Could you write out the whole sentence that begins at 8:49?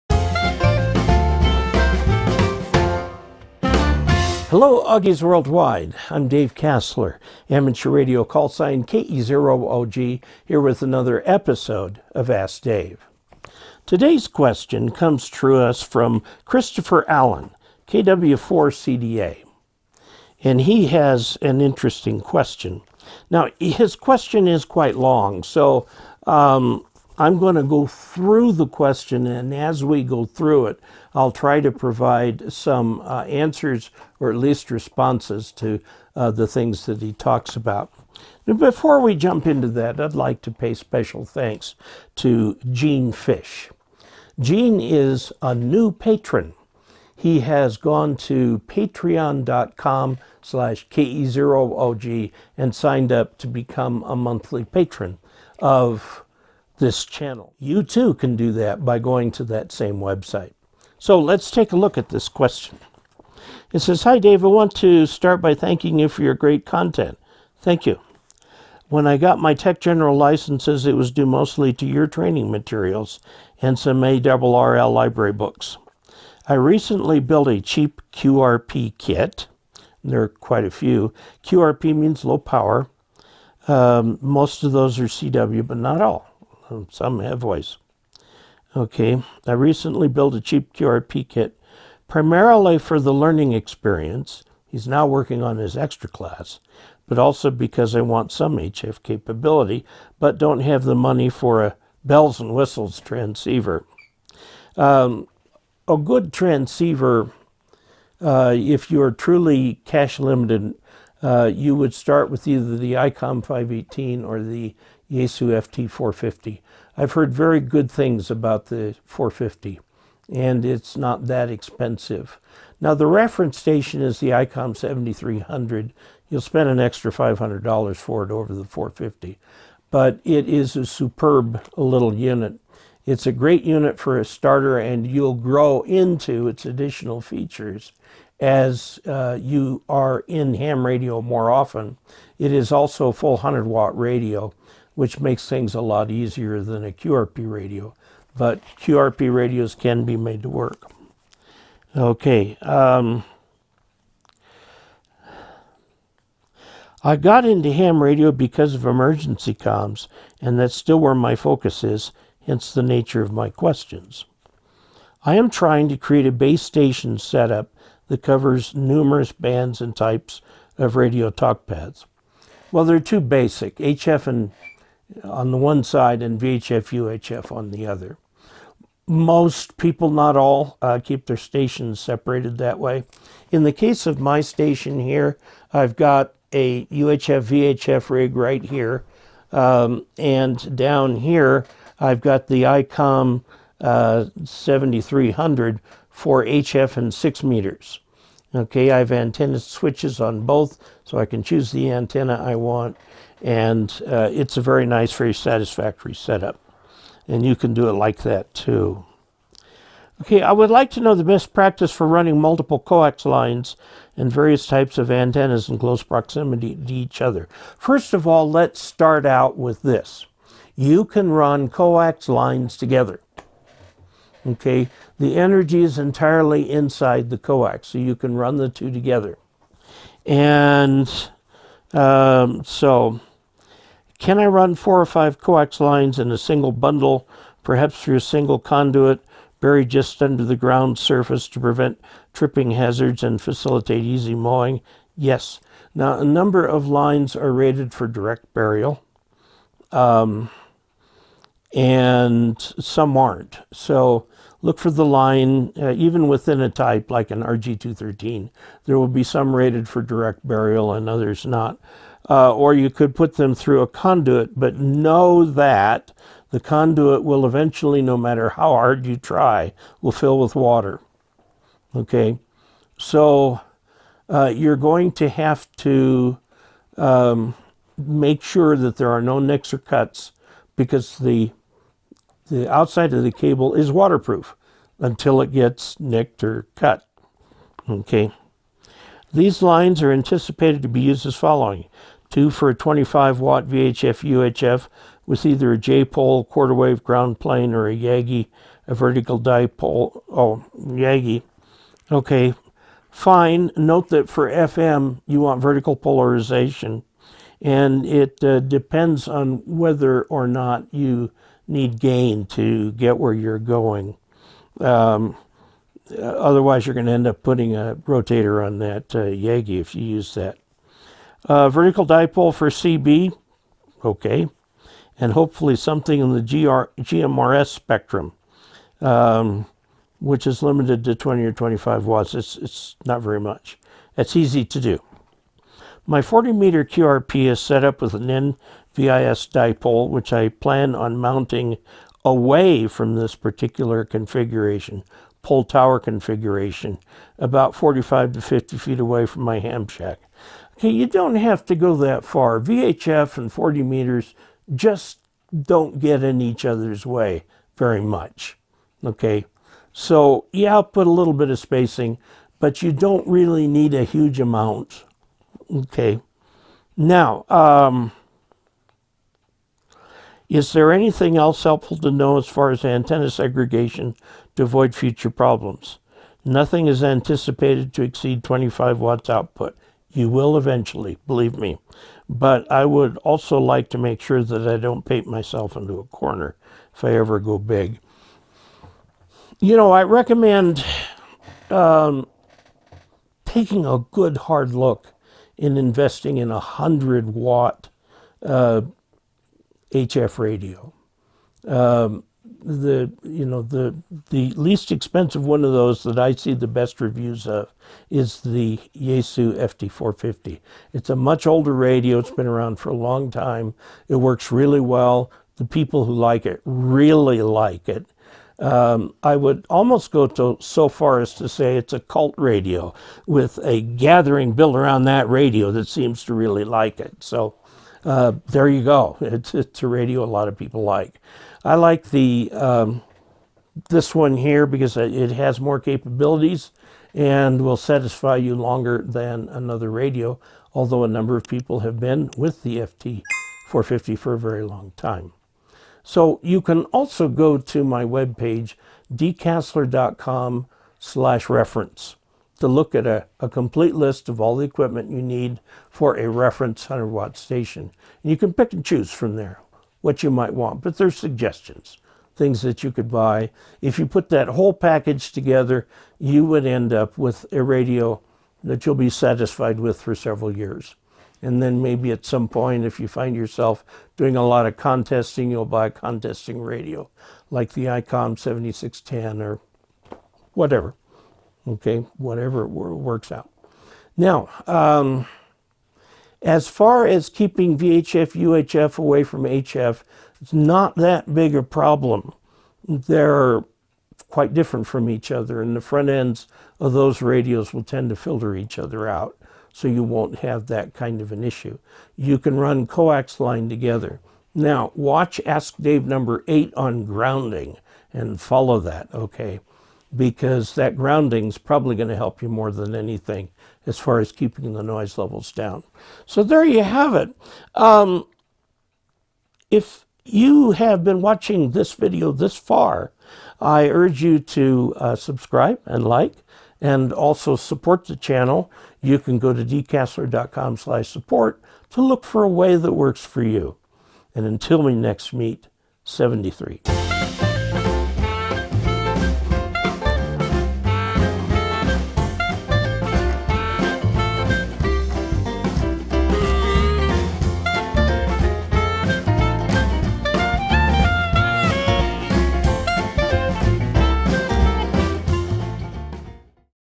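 You can go to dcasler.com slash support to look for a way that works for you.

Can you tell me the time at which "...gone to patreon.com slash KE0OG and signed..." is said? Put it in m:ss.
0:47.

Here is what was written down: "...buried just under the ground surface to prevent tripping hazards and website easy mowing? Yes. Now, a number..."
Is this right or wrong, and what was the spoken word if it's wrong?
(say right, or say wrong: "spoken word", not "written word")
wrong: "facilitate", not "website".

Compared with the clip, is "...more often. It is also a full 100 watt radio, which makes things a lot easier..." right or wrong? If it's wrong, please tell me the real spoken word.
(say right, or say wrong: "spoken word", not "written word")
right.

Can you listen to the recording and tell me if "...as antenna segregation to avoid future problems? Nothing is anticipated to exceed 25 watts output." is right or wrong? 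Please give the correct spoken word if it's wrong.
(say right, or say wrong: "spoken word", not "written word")
right.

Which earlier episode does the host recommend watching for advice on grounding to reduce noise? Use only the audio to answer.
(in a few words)
Ask Dave number 8.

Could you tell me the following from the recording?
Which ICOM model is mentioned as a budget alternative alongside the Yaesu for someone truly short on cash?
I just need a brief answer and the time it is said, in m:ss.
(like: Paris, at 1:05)
ICOM 518, at 1:52.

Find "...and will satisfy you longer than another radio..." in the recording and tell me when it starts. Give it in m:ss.
7:17.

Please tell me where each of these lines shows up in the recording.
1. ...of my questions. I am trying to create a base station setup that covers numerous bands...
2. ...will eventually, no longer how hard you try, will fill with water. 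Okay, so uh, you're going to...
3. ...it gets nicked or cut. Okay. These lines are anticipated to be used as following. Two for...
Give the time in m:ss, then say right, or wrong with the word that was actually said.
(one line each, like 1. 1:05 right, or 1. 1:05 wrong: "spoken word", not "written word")
1. 2:43 right
2. 4:27 wrong: "matter", not "longer"
3. 4:45 right.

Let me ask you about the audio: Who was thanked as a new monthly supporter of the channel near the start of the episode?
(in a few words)
Gene Fish.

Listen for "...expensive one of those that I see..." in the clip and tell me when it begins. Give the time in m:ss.
6:44.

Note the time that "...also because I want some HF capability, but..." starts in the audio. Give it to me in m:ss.
1:37.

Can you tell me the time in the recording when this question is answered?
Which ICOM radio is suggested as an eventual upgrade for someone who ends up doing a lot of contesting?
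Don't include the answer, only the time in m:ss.
7:57.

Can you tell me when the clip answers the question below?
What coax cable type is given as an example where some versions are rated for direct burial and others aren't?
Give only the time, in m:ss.
4:17.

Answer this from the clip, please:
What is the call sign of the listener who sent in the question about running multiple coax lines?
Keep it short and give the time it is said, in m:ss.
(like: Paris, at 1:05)
KW4CDA, at 0:17.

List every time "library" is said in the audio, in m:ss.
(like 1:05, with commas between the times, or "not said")
1:14.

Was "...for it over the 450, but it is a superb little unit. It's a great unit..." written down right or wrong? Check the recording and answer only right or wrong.
right.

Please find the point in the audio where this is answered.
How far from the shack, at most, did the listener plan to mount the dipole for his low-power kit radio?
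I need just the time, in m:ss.
5:48.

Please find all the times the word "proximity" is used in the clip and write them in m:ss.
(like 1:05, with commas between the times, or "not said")
3:36.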